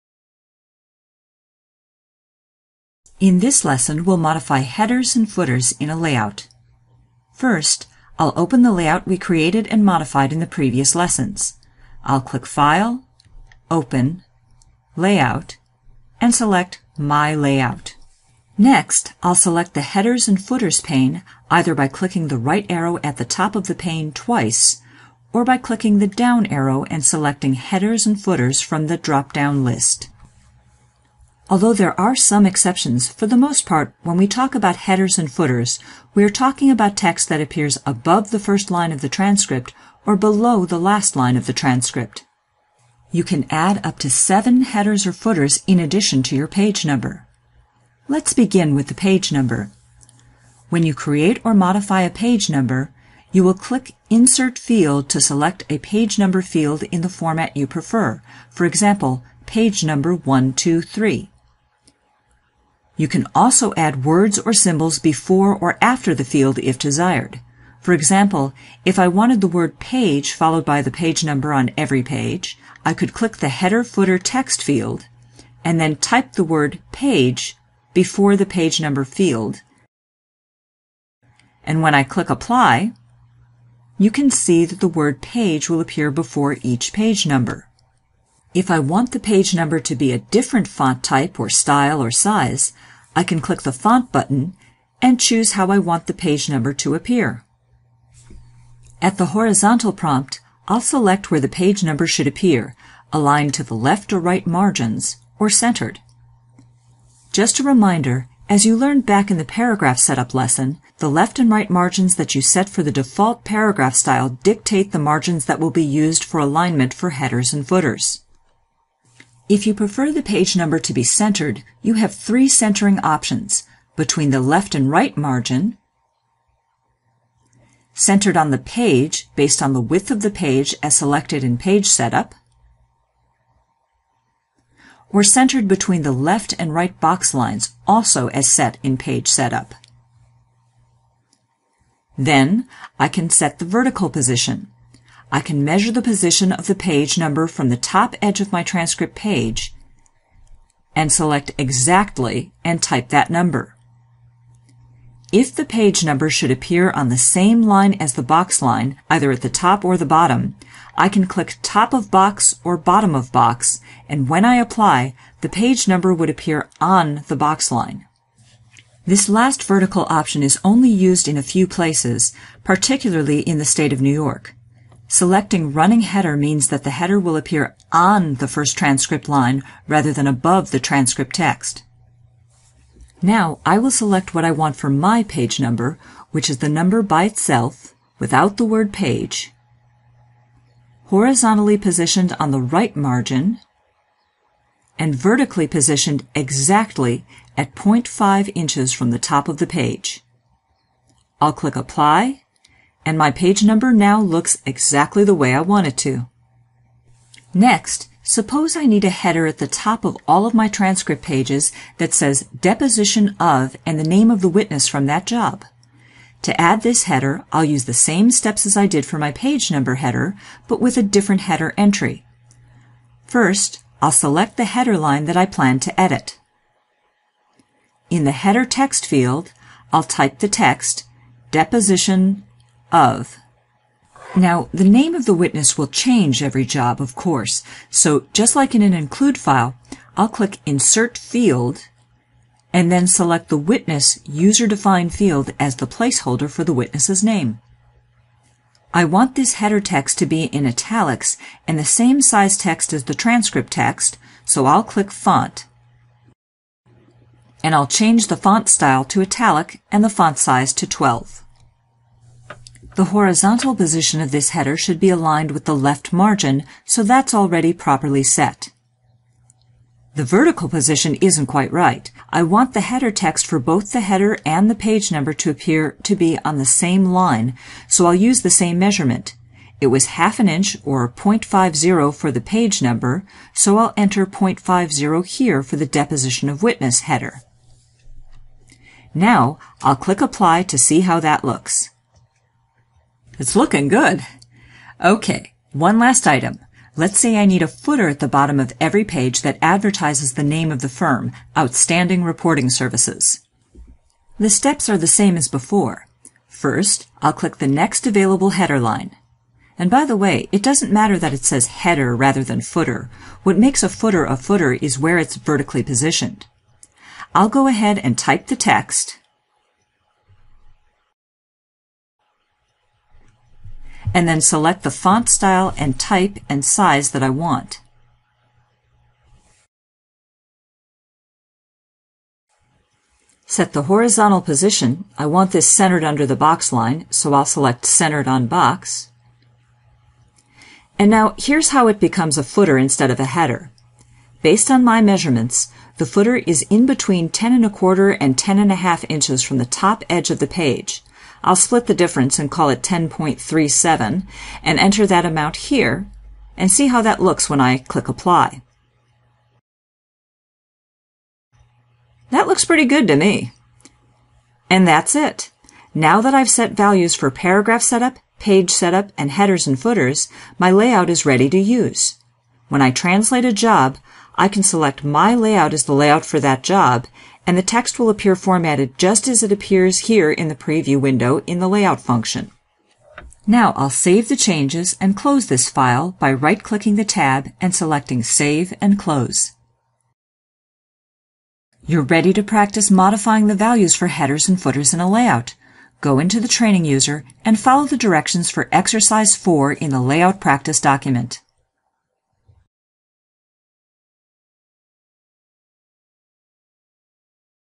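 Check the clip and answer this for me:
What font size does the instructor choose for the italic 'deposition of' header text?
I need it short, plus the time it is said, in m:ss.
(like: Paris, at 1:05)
12, at 4:20.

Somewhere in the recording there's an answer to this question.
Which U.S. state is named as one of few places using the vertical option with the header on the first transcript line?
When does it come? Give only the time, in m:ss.
2:54.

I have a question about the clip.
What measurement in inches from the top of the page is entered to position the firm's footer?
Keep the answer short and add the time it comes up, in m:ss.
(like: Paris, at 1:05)
10.37, at 5:52.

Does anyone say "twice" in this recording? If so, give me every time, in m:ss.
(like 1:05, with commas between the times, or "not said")
0:24.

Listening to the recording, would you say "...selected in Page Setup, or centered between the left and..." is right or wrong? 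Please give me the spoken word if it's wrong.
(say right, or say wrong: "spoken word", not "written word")
right.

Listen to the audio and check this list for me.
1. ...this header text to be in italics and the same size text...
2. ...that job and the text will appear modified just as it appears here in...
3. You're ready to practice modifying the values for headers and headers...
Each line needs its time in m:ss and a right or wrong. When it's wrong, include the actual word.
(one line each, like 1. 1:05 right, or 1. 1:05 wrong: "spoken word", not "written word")
1. 4:09 right
2. 6:16 wrong: "formatted", not "modified"
3. 6:31 wrong: "footers", not "headers".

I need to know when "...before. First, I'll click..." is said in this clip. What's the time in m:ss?
5:05.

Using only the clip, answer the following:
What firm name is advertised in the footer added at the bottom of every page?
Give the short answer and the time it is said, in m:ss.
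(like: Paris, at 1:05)
Outstanding Reporting Services, at 5:01.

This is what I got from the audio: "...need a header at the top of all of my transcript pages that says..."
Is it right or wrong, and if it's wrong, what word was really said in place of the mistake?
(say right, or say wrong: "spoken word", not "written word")
right.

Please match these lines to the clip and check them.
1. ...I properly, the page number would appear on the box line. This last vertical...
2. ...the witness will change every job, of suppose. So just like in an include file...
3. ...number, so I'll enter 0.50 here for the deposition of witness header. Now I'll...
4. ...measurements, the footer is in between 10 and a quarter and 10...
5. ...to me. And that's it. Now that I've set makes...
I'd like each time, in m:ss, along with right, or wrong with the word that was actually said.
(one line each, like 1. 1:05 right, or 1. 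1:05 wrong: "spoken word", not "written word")
1. 2:44 wrong: "apply", not "properly"
2. 3:55 wrong: "course", not "suppose"
3. 4:42 right
4. 5:45 right
5. 6:03 wrong: "values", not "makes".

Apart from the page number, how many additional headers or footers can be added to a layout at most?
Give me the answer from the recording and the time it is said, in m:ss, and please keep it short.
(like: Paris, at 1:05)
7, at 0:44.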